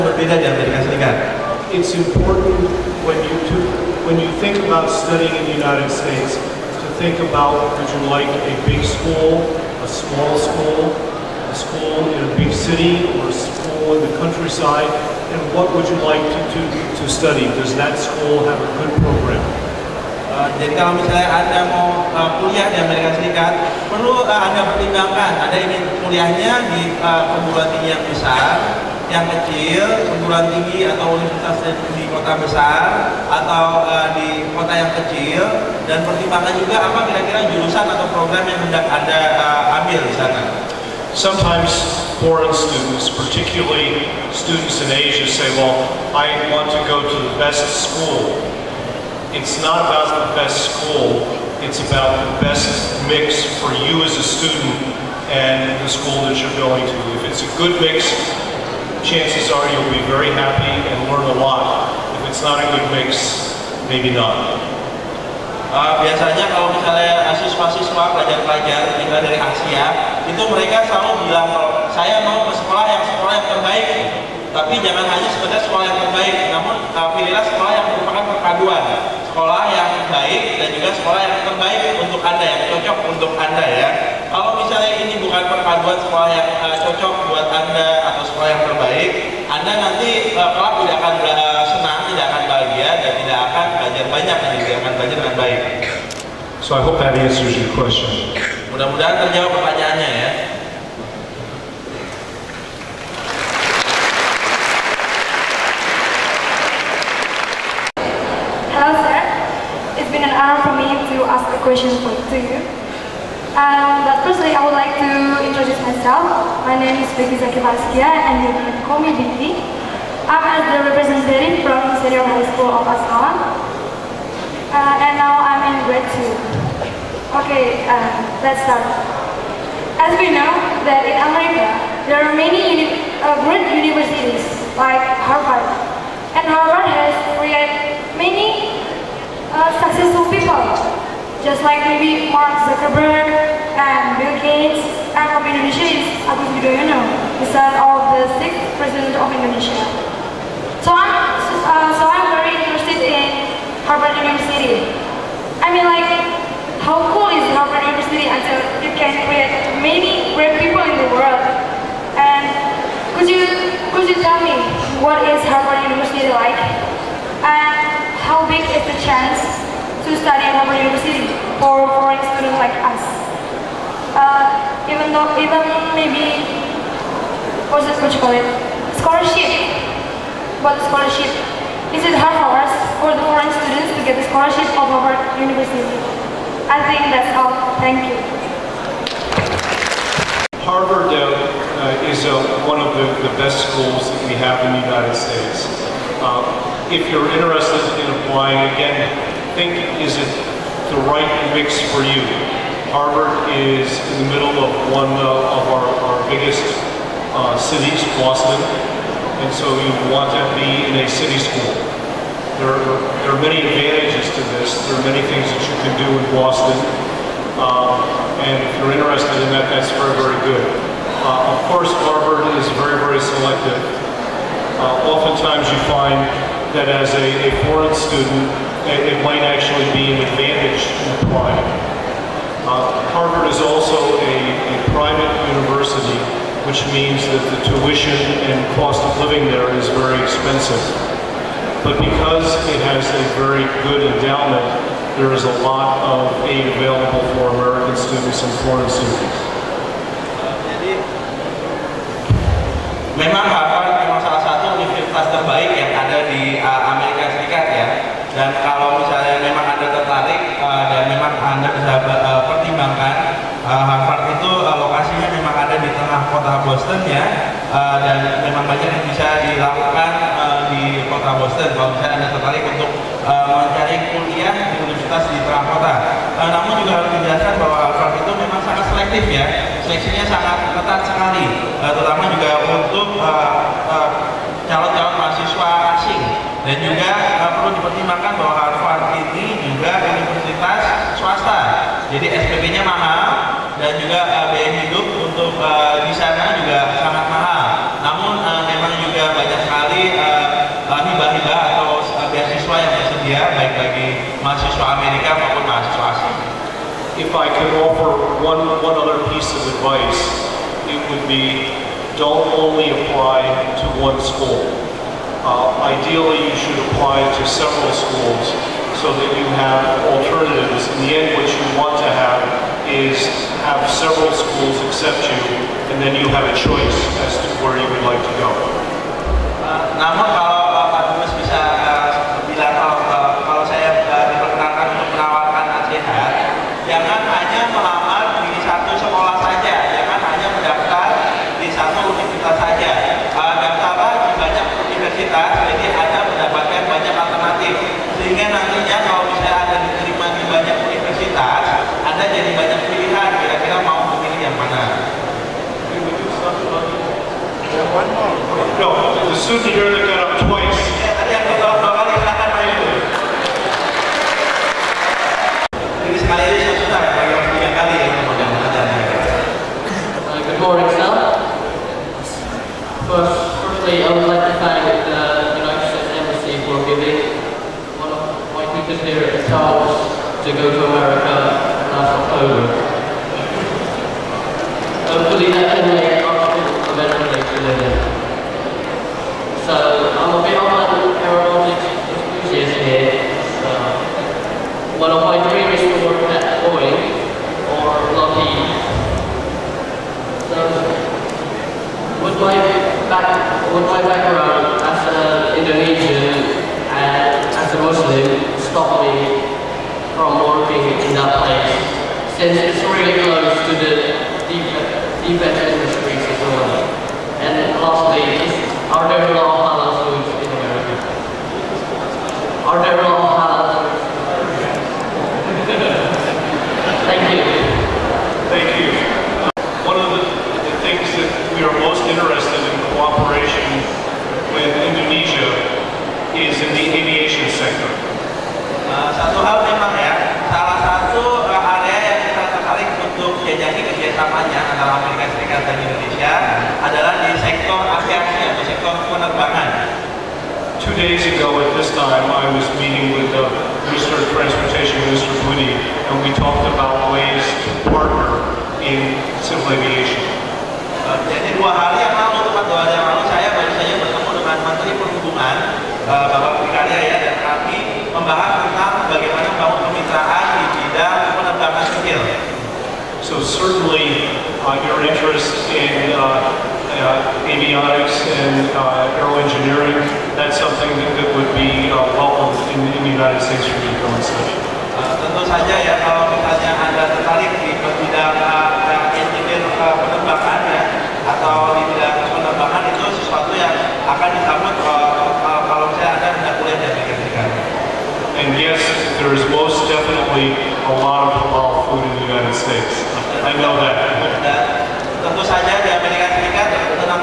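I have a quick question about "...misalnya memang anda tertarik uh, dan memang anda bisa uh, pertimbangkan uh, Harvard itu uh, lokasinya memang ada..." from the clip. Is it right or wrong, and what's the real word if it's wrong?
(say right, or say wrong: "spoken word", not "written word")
right.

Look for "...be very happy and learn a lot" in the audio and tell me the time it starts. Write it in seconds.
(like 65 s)
59 s.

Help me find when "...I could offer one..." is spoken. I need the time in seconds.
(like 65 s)
307 s.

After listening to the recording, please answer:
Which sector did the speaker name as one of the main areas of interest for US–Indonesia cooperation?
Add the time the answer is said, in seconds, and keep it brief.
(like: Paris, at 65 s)
Aviation sector, at 436 s.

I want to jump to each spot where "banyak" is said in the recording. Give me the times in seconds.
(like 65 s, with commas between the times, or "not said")
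94 s, 268 s, 299 s.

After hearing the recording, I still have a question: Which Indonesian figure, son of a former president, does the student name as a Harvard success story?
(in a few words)
Agus Yudhoyono.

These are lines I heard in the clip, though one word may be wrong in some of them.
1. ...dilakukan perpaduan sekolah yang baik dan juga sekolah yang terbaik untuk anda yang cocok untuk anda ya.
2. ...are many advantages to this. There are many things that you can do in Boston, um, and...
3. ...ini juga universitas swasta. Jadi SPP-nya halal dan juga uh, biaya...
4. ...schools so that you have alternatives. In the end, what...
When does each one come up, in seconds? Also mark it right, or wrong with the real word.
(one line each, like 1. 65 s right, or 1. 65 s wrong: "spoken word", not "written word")
1. 77 s wrong: "merupakan", not "dilakukan"
2. 213 s right
3. 289 s wrong: "mahal", not "halal"
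4. 317 s right.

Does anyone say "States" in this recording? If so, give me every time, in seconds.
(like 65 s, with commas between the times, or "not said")
5 s, 195 s, 483 s, 502 s.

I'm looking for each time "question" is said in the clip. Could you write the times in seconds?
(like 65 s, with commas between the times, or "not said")
97 s, 111 s.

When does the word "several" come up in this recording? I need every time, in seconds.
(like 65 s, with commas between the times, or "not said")
317 s, 323 s.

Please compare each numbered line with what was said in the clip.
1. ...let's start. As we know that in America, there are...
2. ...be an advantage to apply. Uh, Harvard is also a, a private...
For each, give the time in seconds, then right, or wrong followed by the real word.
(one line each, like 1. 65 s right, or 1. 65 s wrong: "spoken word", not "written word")
1. 128 s right
2. 229 s right.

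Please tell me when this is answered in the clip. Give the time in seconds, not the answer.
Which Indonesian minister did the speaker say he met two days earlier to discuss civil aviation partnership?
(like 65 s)
455 s.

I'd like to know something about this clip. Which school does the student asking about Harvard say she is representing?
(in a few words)
Senior High School of Aswan.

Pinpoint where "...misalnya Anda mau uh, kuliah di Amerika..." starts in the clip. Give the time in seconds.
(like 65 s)
20 s.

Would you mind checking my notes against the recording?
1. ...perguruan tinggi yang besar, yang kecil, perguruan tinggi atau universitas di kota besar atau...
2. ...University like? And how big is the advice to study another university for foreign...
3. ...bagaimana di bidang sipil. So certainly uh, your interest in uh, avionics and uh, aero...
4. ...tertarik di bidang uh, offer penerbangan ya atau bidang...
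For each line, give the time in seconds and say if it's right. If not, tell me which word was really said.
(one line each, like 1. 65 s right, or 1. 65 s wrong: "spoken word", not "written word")
1. 27 s right
2. 165 s wrong: "chance", not "advice"
3. 469 s right
4. 487 s wrong: "engineer", not "offer".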